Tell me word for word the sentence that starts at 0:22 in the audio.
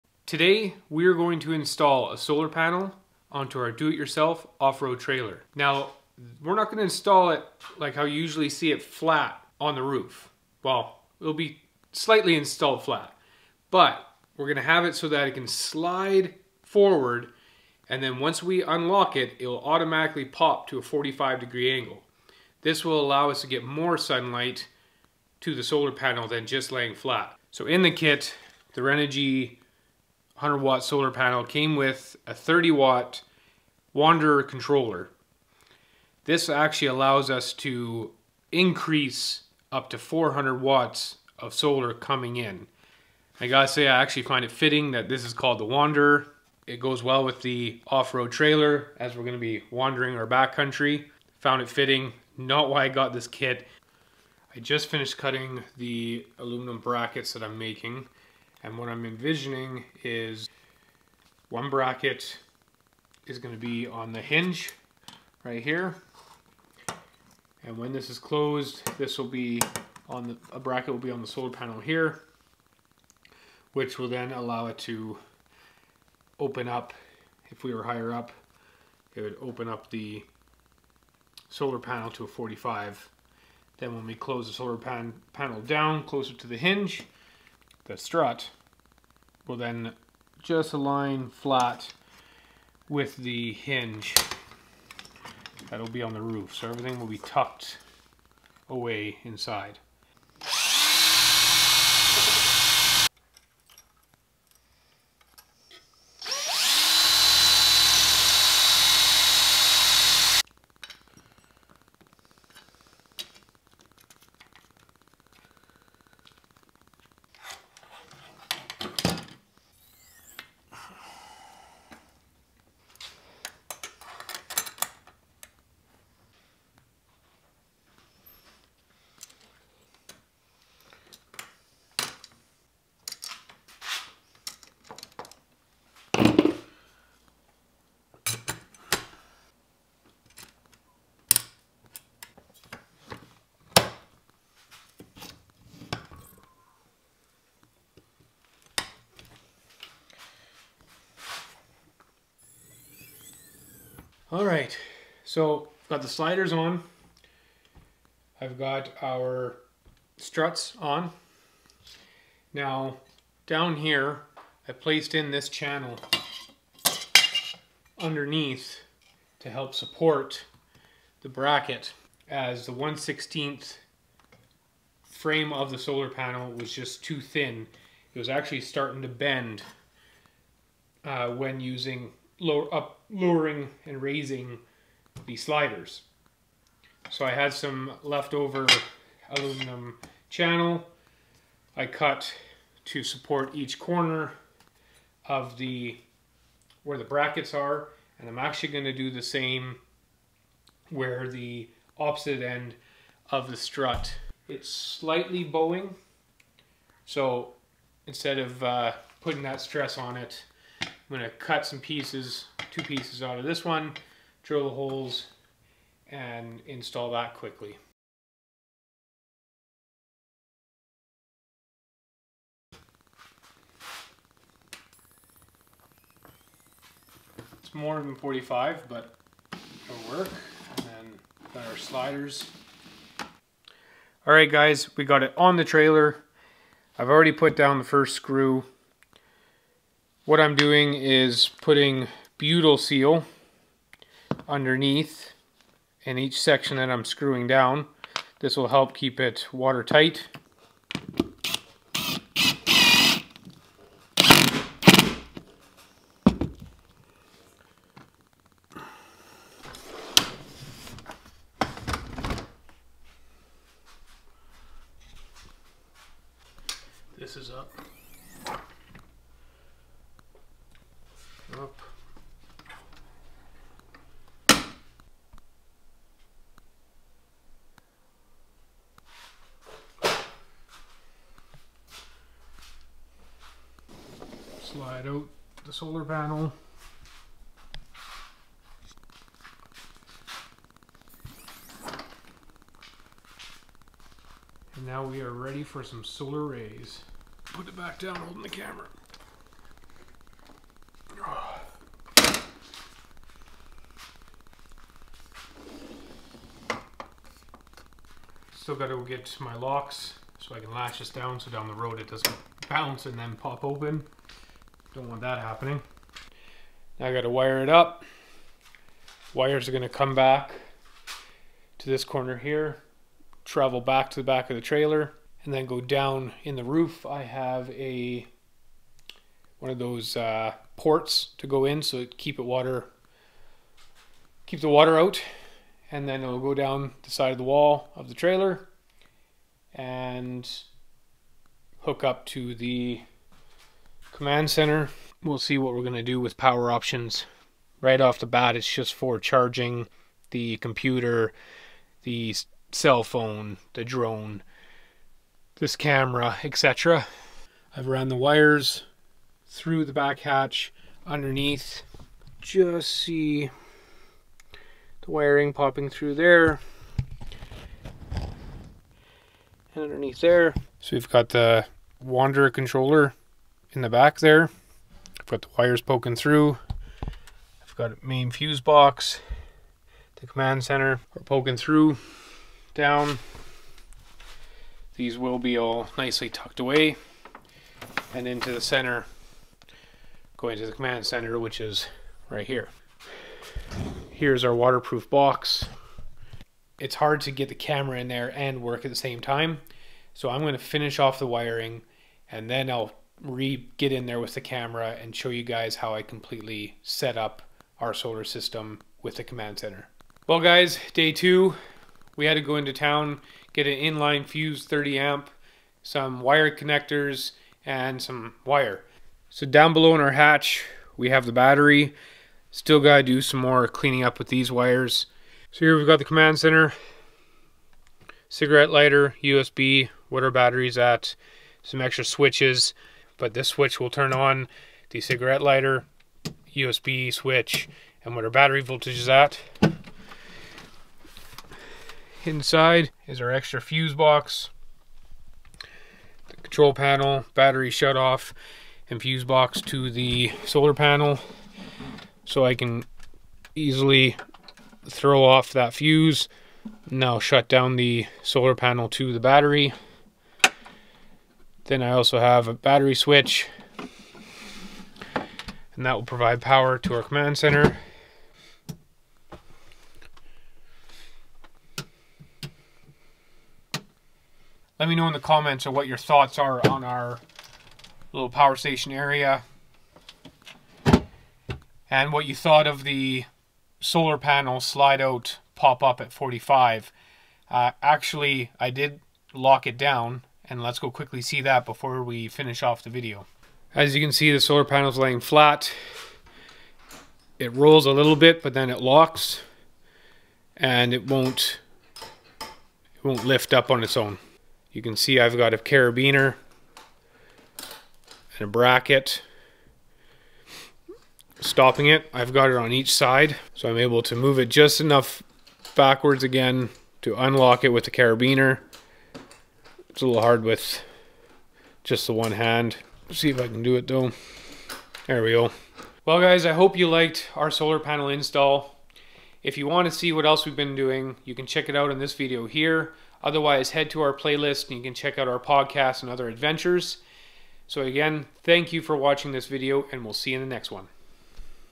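This will allow us to get more sunlight to the solar panel than just laying flat.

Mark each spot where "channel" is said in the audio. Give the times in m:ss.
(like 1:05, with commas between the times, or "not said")
2:45, 3:10.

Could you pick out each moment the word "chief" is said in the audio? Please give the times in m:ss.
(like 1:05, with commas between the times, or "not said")
not said.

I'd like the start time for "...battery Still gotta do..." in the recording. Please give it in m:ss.
7:01.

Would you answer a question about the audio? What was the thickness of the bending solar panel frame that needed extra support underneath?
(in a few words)
1/16.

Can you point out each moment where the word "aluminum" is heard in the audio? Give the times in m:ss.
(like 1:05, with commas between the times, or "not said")
0:56, 3:09.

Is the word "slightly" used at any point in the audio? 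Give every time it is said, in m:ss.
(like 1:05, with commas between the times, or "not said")
0:11, 3:24.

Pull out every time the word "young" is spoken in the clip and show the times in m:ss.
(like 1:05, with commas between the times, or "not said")
not said.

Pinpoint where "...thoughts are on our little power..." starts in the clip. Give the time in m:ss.
7:55.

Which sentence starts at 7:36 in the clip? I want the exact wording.
Now shut down the solar panel to the battery.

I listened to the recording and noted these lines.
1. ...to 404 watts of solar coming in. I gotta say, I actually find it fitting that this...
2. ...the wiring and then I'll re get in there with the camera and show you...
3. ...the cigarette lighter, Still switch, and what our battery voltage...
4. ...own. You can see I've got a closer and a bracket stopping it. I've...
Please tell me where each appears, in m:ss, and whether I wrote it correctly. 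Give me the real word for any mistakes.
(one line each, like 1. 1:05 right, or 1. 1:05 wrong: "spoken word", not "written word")
1. 0:39 wrong: "400", not "404"
2. 6:41 right
3. 7:14 wrong: "USB", not "Still"
4. 8:23 wrong: "carabiner", not "closer".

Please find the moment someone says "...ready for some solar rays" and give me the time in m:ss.
4:55.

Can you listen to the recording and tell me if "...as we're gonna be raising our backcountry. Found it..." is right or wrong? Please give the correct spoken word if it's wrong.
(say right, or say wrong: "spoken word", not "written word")
wrong: "wandering", not "raising".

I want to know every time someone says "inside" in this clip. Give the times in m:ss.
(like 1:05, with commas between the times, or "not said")
1:39, 7:22.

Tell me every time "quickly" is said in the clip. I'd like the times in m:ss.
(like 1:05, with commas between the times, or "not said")
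3:37, 8:10.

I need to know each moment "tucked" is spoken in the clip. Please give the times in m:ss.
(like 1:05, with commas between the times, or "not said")
1:37, 6:26.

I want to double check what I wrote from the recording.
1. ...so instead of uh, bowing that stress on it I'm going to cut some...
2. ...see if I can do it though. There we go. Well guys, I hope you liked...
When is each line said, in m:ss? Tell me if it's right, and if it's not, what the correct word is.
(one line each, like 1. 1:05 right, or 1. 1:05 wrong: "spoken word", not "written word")
1. 3:27 wrong: "putting", not "bowing"
2. 8:43 right.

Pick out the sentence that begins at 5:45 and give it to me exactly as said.
We'll see what we're going to do with power options.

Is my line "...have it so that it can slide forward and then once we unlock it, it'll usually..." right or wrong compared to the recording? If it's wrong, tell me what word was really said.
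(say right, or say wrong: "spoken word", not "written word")
wrong: "automatically", not "usually".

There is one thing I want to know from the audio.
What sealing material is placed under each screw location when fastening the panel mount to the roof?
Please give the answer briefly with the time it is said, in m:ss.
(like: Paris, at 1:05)
Butyl seal, at 4:02.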